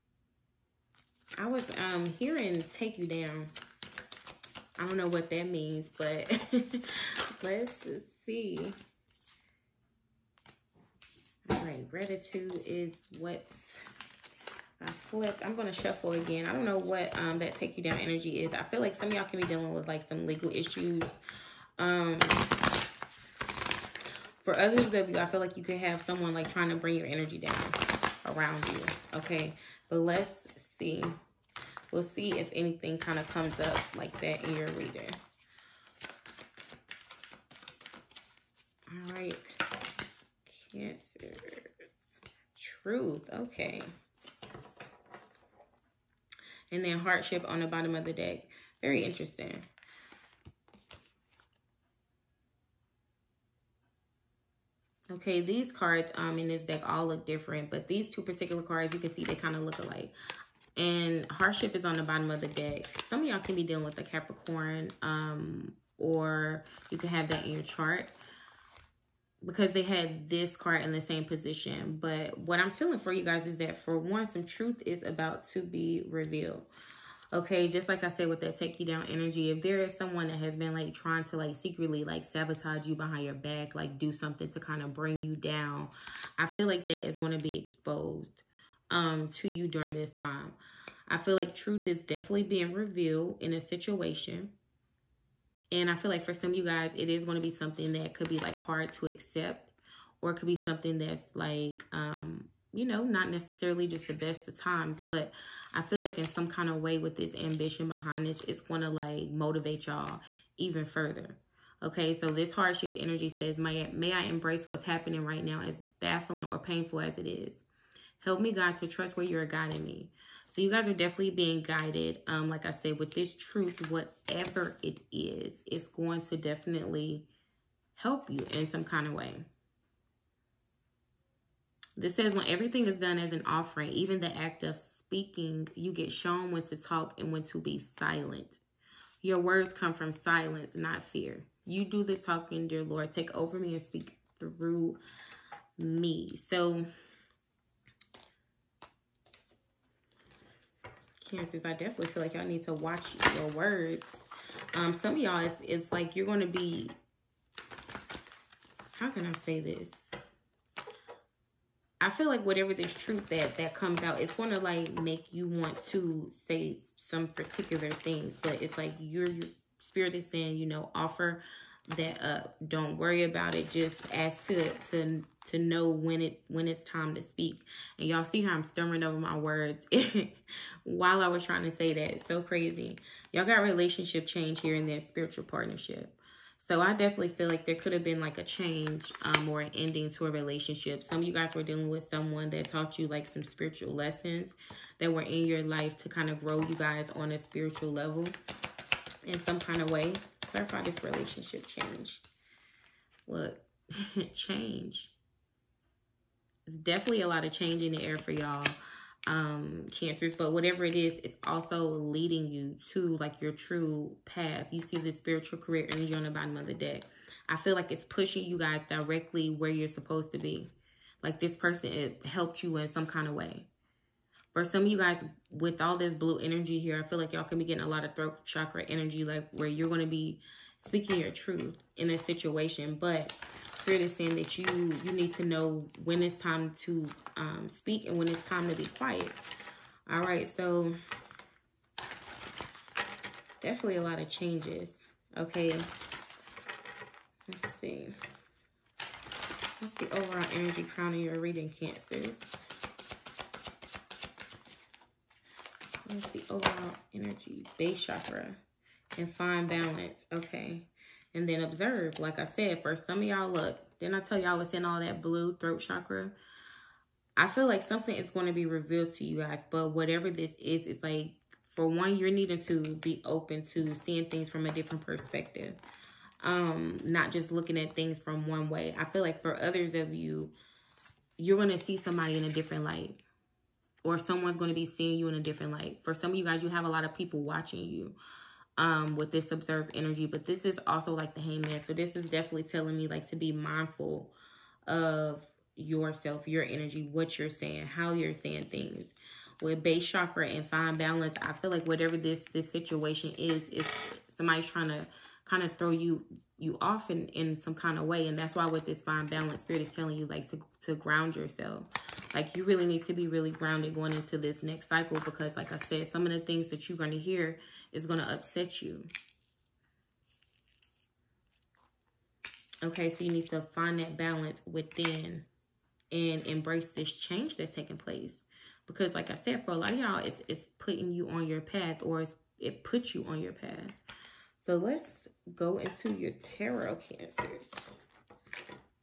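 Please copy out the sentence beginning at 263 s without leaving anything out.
Then I tell y'all what's in all that blue throat chakra.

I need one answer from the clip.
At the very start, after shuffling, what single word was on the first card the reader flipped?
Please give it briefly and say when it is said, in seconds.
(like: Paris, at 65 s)
Gratitude, at 11 s.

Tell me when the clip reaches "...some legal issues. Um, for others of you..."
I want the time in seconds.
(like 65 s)
20 s.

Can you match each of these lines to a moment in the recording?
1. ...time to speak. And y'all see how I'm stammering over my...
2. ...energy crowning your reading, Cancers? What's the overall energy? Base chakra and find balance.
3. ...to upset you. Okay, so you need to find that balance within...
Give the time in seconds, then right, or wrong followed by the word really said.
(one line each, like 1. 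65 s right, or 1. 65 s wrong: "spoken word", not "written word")
1. 176 s right
2. 250 s right
3. 318 s right.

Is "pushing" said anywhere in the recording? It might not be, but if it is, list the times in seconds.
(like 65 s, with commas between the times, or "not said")
218 s.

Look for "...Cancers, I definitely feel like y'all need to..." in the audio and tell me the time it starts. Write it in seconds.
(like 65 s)
151 s.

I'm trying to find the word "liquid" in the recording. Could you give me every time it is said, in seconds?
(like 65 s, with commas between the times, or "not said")
not said.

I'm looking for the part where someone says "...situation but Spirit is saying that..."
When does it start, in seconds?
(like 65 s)
232 s.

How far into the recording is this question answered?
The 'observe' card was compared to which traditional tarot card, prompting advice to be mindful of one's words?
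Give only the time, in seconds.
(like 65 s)
291 s.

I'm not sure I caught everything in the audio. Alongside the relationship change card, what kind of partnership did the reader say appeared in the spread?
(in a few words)
Spiritual partnership.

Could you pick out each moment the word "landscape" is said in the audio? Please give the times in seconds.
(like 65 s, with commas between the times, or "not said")
not said.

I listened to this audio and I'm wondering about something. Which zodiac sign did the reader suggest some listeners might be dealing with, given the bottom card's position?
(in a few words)
Capricorn.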